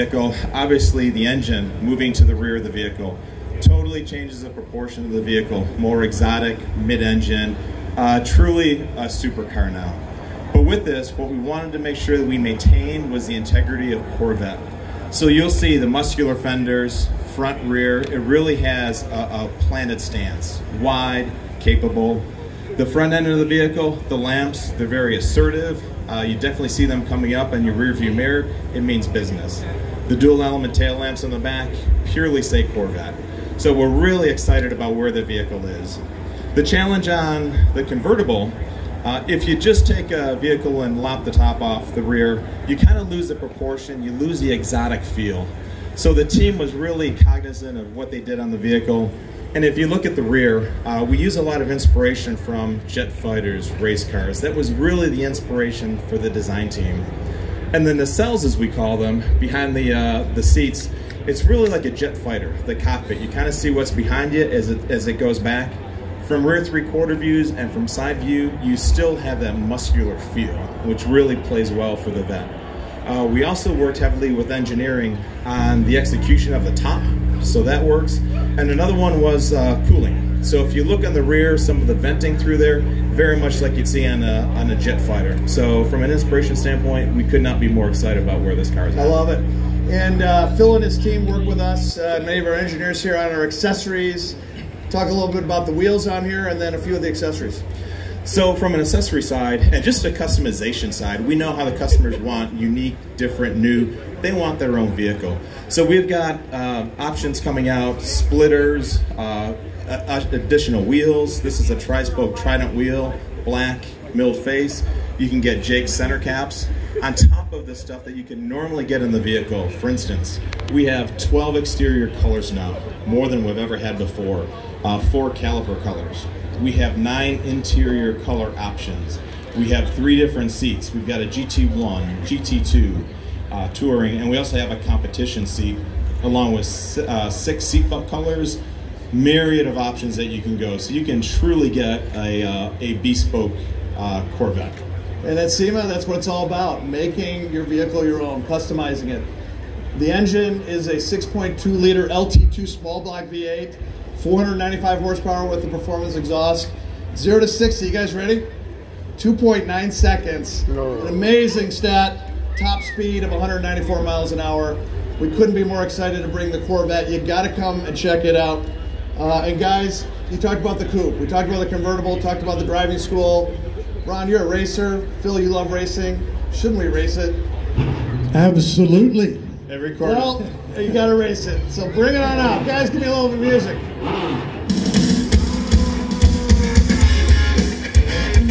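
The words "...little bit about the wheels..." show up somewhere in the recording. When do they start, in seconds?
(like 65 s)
95 s.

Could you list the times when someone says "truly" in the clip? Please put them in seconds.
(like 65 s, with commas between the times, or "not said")
8 s, 141 s.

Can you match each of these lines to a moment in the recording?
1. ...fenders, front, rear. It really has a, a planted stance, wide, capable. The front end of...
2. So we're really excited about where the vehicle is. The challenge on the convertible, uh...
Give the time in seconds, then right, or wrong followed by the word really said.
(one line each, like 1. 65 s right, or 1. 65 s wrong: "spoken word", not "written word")
1. 16 s right
2. 33 s right.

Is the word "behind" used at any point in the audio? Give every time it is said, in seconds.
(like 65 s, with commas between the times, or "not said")
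59 s, 63 s.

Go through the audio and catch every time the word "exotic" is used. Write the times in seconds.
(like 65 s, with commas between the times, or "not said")
6 s, 44 s.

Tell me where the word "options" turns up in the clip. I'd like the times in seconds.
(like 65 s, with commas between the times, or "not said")
106 s, 128 s, 139 s.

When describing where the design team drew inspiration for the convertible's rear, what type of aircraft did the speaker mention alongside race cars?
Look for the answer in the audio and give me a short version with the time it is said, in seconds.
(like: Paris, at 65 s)
jet fighters, at 52 s.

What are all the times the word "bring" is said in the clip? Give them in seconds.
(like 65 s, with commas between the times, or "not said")
166 s, 181 s.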